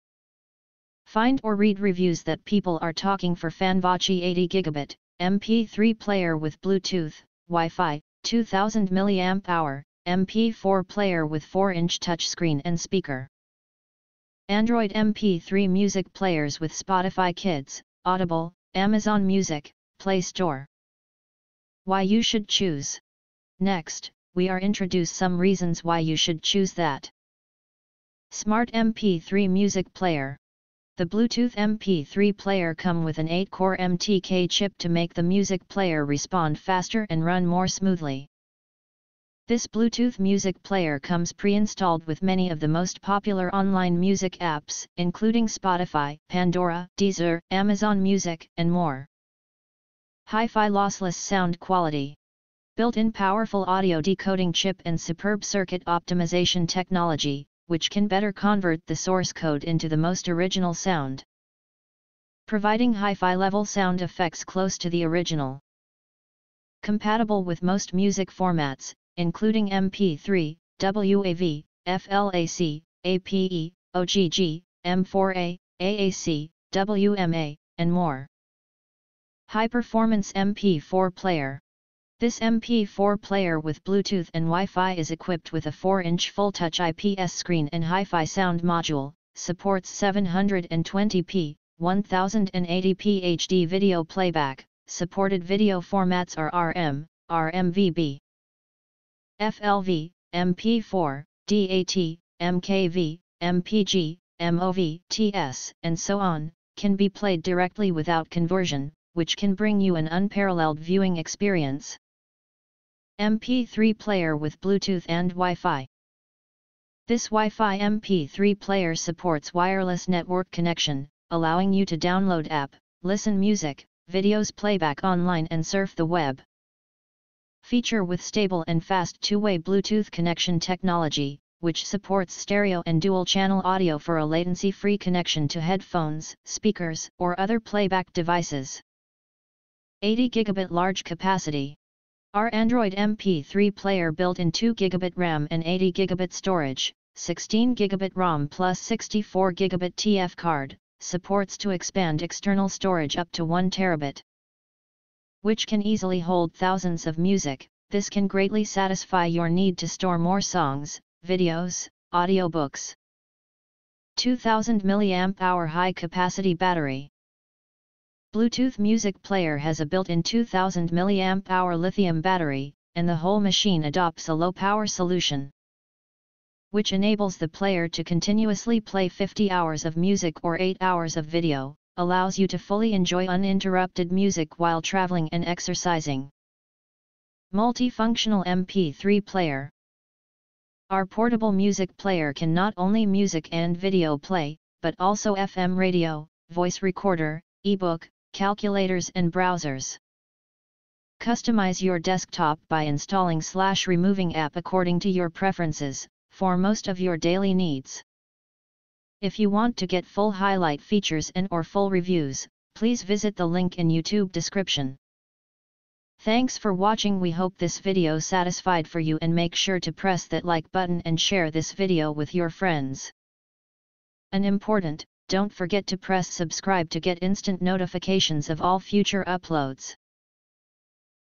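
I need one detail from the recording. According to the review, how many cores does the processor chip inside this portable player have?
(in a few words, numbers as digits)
8.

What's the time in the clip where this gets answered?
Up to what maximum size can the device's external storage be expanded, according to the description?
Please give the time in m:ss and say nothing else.
2:33.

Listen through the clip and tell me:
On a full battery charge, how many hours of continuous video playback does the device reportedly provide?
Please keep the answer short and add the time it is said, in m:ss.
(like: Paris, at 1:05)
8 hours, at 3:00.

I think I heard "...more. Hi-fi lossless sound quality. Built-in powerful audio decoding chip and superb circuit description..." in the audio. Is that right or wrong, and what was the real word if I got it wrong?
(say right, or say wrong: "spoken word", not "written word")
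wrong: "optimization", not "description".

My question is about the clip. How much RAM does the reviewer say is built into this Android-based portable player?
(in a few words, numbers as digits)
2GB.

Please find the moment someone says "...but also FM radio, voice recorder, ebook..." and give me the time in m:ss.
3:14.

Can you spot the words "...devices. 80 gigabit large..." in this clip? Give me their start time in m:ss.
2:18.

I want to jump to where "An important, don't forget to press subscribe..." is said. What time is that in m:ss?
3:44.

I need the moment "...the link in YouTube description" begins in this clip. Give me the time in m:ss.
3:33.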